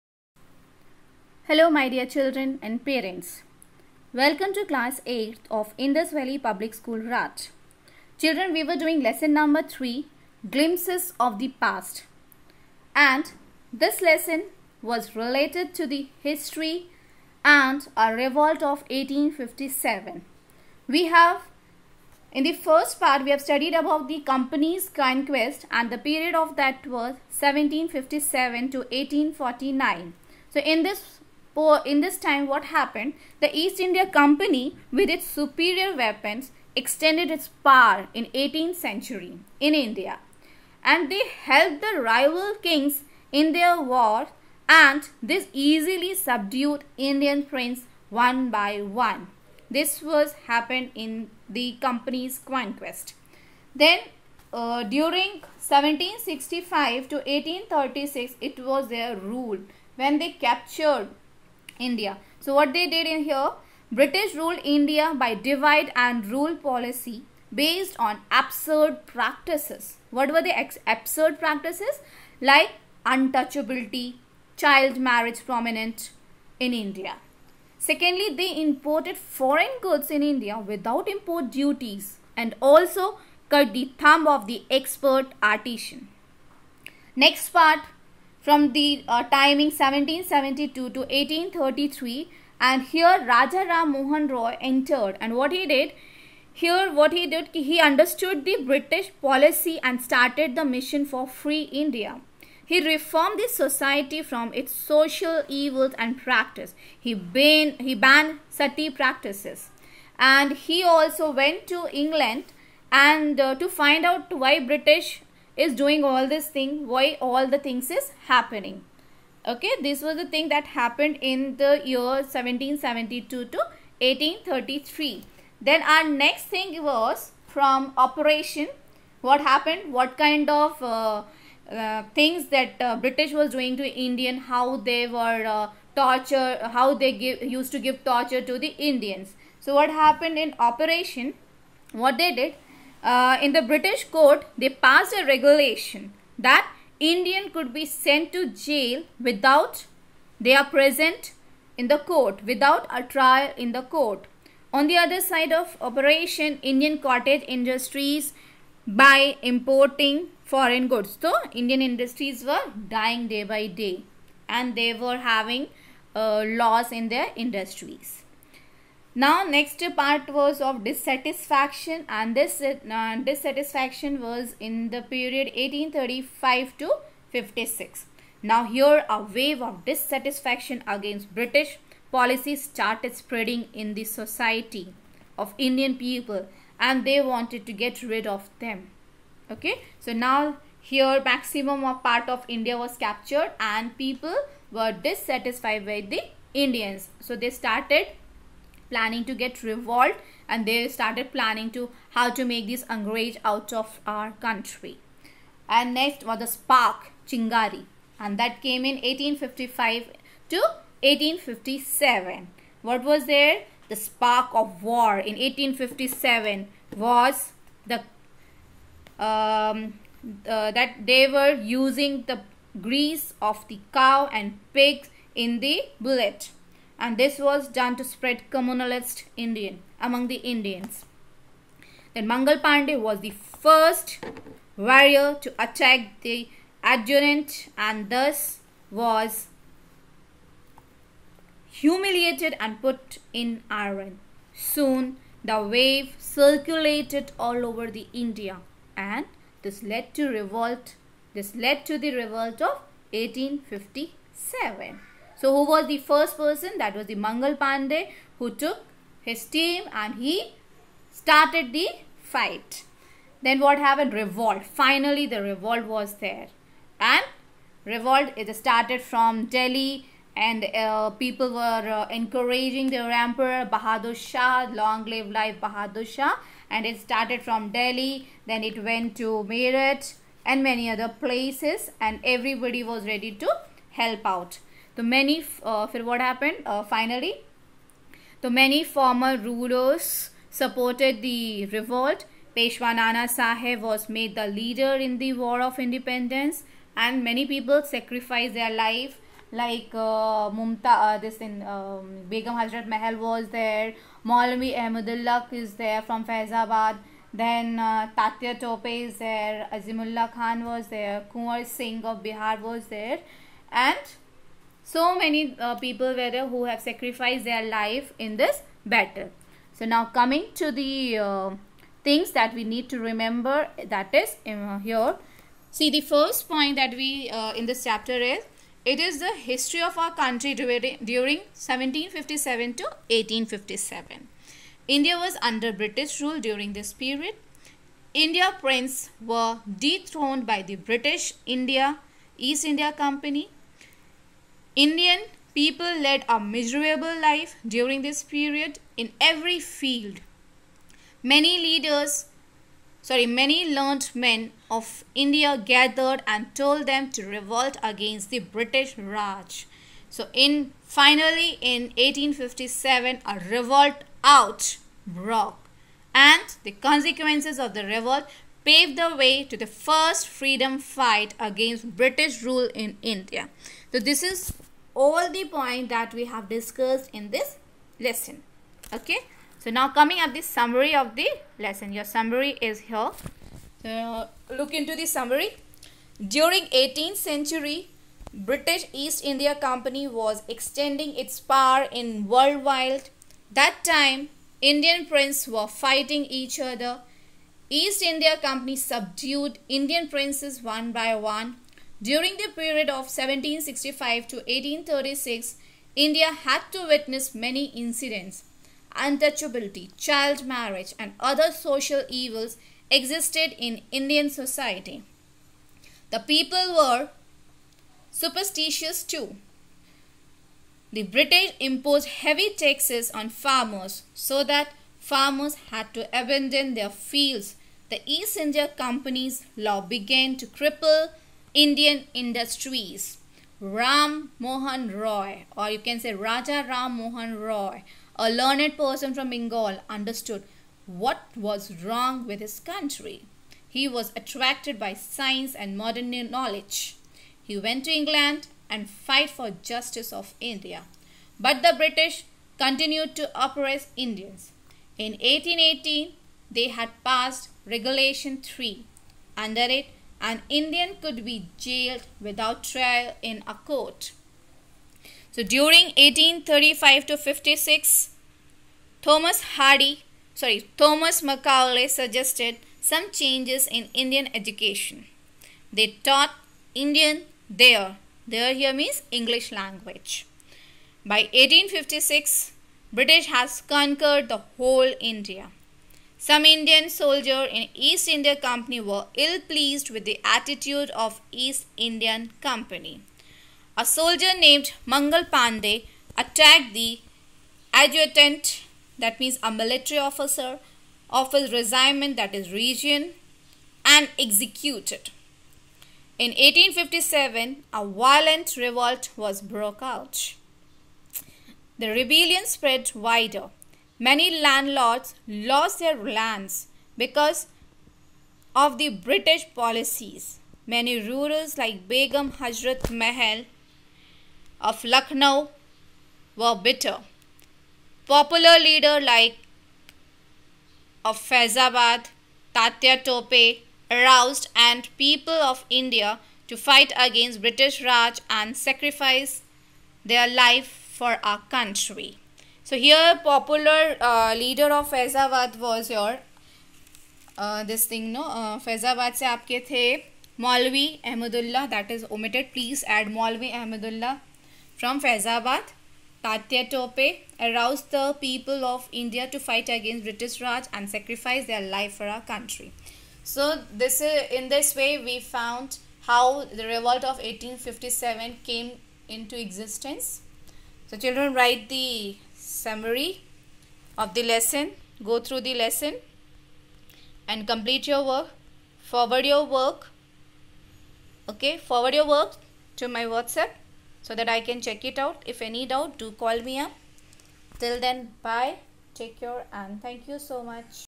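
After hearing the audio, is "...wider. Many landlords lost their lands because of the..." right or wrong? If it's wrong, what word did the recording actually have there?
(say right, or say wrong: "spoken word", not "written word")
right.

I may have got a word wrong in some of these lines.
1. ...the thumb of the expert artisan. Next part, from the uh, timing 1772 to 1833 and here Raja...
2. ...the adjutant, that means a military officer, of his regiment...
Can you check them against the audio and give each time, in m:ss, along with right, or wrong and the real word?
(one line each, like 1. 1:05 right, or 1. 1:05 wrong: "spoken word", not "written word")
1. 1:23 right
2. 8:16 right.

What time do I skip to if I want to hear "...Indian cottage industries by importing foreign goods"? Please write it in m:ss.
2:36.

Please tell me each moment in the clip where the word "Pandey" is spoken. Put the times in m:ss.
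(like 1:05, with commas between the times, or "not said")
3:52, 4:17, 8:15.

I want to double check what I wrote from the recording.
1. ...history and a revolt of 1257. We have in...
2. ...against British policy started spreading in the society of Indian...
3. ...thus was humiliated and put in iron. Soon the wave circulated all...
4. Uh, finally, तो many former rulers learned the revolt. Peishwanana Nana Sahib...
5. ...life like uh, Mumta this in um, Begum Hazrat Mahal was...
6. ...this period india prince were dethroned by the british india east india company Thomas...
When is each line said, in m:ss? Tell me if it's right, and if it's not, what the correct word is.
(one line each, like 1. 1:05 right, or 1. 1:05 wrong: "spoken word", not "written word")
1. 0:16 wrong: "1857", not "1257"
2. 3:00 right
3. 3:58 right
4. 4:46 wrong: "supported", not "learned"
5. 4:58 right
6. 5:36 wrong: "Indian", not "Thomas".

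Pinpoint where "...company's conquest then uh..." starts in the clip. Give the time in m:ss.
0:51.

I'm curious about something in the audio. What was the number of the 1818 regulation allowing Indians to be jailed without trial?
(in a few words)
3.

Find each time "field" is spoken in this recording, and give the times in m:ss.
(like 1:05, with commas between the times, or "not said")
5:49, 7:06.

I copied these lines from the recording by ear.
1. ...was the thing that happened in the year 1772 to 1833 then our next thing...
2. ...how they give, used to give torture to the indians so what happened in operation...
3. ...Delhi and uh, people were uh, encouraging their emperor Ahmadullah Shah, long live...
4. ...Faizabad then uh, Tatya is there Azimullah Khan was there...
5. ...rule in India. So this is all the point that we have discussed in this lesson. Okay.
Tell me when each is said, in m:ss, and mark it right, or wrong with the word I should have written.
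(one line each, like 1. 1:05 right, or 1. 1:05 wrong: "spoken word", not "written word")
1. 2:00 right
2. 2:16 right
3. 4:29 wrong: "Bahadur", not "Ahmadullah"
4. 5:06 right
5. 6:12 right.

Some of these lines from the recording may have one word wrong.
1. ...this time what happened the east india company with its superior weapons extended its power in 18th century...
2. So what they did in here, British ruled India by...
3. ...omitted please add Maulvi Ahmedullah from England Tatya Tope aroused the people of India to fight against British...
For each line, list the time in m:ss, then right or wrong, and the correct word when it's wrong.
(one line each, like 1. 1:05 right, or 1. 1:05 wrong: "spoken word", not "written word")
1. 0:32 right
2. 1:02 right
3. 9:12 wrong: "Faizabad", not "England".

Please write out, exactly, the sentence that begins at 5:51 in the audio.
Many leaders, sorry, many learned men of India gathered and told them to revolt against the British Raj.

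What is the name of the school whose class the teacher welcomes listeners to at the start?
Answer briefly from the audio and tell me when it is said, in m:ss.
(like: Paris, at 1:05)
Indus Valley Public School, at 0:05.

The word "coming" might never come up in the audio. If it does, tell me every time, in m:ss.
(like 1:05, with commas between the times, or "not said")
5:20, 6:19.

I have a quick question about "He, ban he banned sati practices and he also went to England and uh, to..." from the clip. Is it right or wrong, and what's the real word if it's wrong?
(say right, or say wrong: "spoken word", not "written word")
right.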